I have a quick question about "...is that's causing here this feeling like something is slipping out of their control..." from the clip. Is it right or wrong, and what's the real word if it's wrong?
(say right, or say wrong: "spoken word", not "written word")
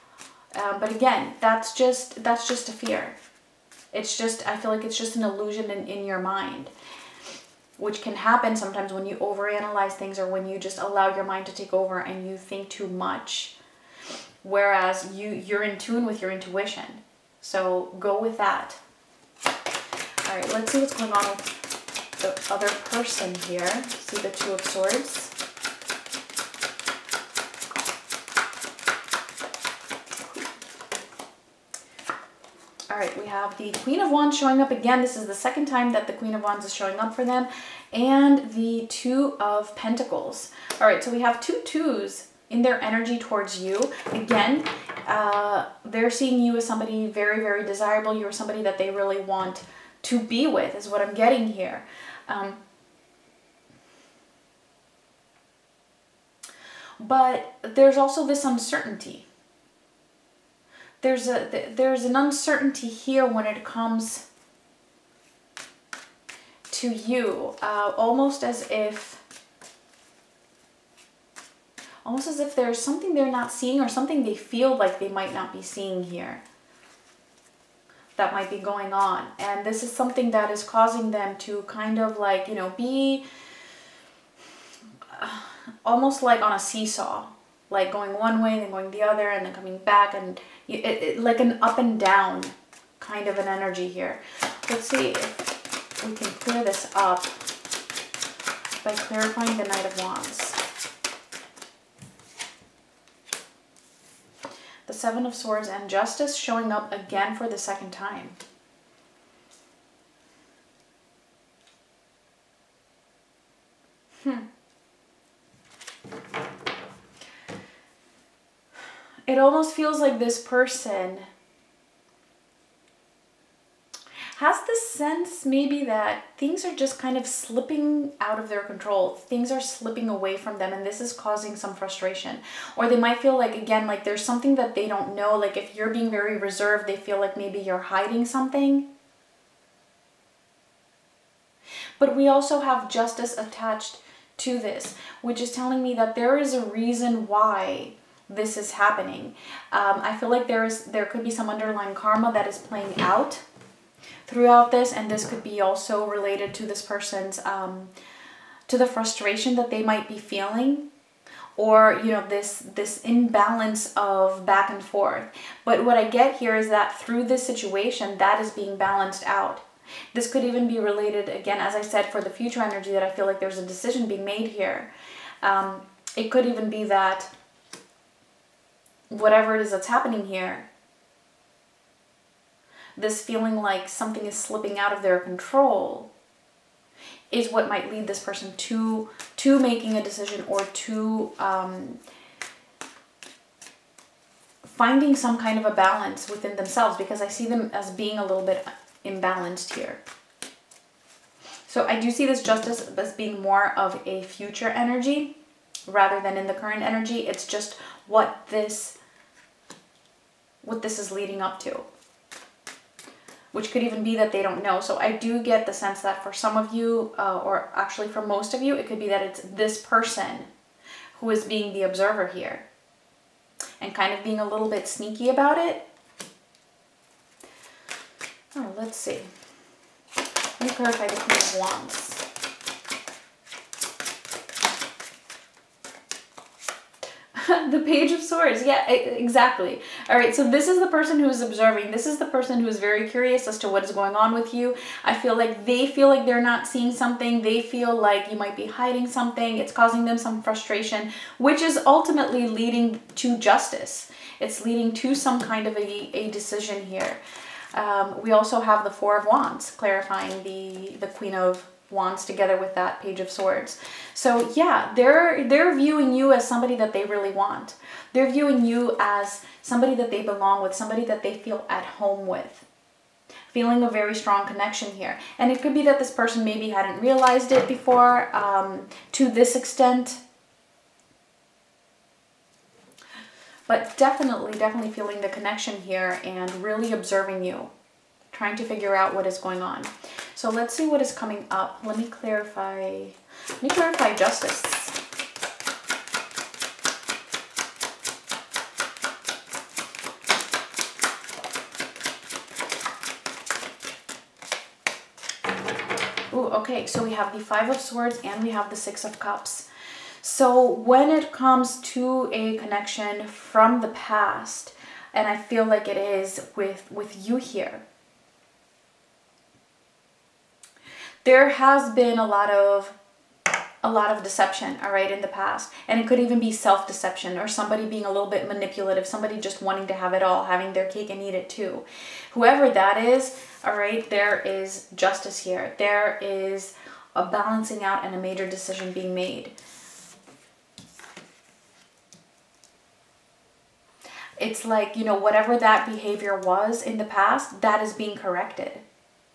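wrong: "happening", not "causing".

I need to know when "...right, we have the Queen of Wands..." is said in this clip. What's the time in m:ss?
0:32.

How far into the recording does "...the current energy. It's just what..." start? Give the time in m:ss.
3:26.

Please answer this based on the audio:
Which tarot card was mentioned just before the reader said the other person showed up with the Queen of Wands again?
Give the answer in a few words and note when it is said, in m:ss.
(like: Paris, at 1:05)
Two of Swords, at 0:24.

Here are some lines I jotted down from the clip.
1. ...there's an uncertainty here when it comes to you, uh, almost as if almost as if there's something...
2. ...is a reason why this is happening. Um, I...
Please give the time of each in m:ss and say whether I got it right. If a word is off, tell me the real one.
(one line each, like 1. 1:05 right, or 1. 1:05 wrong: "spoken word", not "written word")
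1. 1:01 right
2. 2:26 right.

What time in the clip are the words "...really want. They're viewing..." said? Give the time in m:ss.
4:27.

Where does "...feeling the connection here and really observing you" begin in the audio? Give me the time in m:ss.
4:44.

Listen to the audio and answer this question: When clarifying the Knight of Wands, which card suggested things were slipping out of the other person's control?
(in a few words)
Seven of Swords.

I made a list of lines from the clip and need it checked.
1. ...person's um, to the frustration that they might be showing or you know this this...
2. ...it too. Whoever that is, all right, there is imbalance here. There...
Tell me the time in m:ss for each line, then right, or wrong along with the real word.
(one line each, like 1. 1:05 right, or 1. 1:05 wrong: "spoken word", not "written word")
1. 2:36 wrong: "feeling", not "showing"
2. 5:31 wrong: "justice", not "imbalance".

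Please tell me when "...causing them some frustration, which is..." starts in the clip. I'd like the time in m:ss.
4:09.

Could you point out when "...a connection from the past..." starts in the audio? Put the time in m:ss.
5:12.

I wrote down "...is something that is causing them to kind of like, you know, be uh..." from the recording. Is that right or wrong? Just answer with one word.
right.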